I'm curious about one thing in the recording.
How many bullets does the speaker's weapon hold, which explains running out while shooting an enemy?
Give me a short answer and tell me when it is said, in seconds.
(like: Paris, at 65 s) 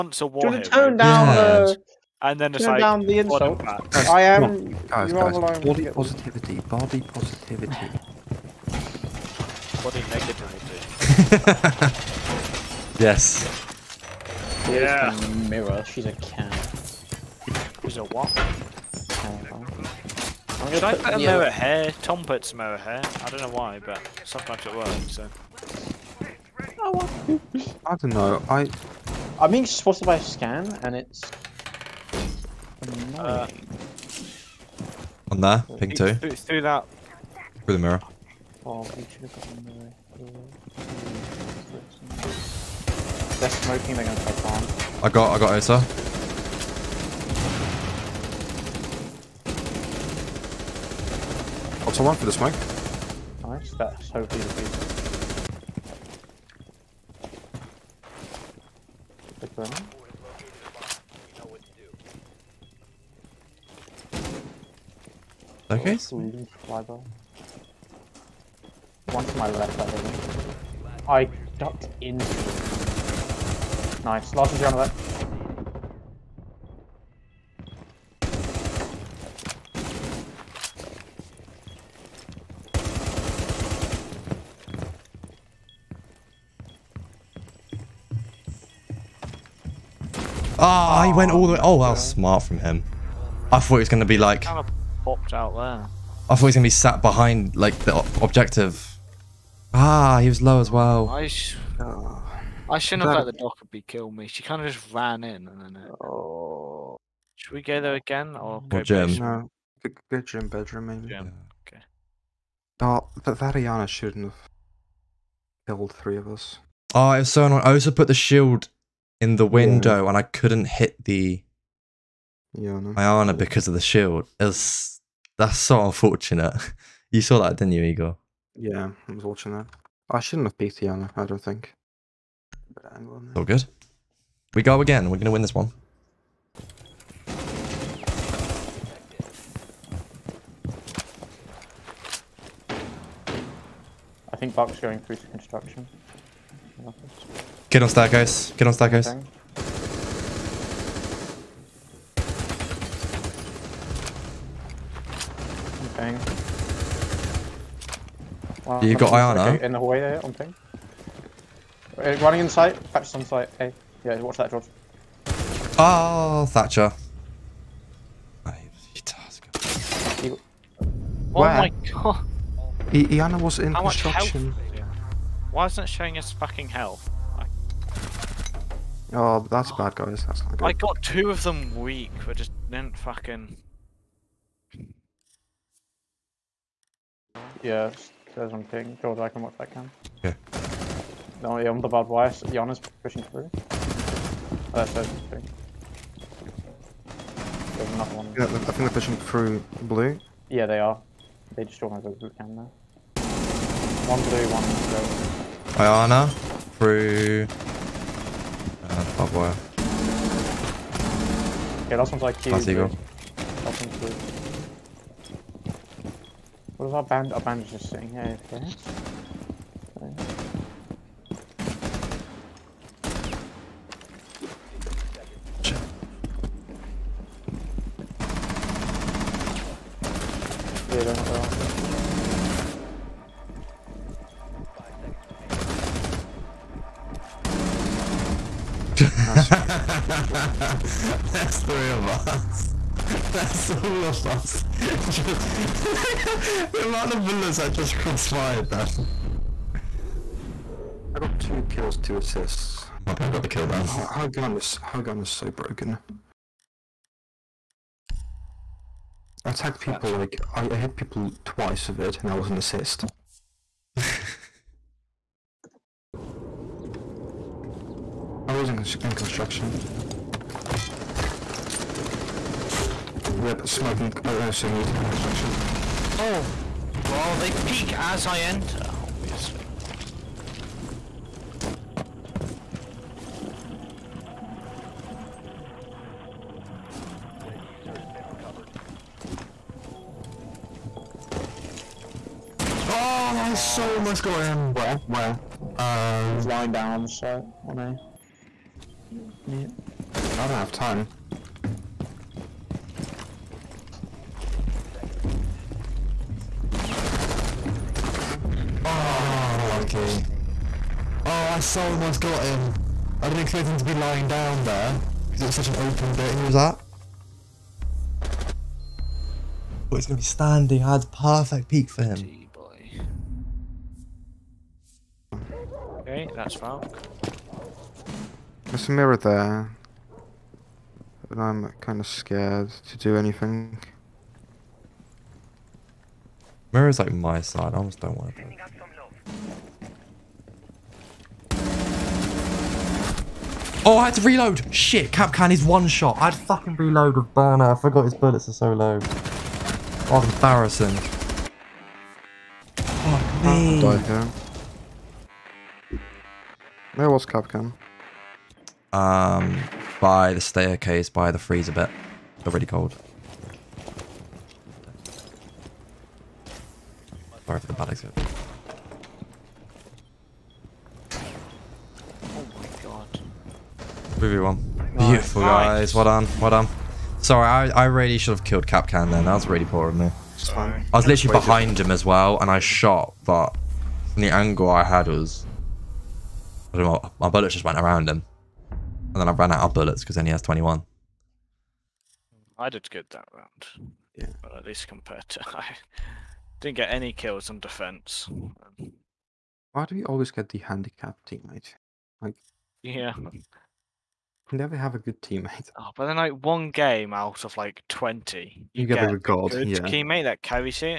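21, at 390 s.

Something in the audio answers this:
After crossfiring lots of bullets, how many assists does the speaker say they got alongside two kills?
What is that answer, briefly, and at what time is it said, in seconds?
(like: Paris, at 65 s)
2, at 251 s.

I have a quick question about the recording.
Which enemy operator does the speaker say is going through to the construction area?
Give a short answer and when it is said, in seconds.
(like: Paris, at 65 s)
Buck, at 144 s.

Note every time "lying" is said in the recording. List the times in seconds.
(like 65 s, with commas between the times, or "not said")
296 s, 313 s.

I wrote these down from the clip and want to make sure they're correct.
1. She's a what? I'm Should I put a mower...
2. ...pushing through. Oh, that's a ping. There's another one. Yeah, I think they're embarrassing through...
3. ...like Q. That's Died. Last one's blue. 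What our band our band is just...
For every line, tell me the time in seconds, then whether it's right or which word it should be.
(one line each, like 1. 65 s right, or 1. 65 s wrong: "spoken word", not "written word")
1. 17 s right
2. 193 s wrong: "pushing", not "embarrassing"
3. 212 s wrong: "Eagle", not "Died".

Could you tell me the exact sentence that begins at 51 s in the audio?
Got oh, someone for the smoke.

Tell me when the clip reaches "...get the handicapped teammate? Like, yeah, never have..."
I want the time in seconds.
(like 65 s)
400 s.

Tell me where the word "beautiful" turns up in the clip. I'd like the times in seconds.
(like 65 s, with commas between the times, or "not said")
54 s, 375 s.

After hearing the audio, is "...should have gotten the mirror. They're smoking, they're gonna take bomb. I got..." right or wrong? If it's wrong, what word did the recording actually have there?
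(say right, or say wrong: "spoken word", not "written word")
right.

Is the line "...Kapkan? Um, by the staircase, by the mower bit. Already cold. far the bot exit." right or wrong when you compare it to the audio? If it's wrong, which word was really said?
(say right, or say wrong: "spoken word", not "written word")
wrong: "freezer", not "mower".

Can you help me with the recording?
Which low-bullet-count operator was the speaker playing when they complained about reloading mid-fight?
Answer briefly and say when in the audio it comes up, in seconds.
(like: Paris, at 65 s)
Burner, at 347 s.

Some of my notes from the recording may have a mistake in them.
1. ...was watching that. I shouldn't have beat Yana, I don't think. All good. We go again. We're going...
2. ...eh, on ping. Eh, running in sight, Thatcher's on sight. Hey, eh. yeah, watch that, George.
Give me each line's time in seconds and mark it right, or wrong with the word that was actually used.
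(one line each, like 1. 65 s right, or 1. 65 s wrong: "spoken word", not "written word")
1. 129 s right
2. 160 s right.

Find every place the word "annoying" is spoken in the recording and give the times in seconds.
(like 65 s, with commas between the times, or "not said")
32 s, 117 s.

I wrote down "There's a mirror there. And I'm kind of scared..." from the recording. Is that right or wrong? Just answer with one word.
right.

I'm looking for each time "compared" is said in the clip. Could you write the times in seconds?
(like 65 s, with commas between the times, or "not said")
394 s.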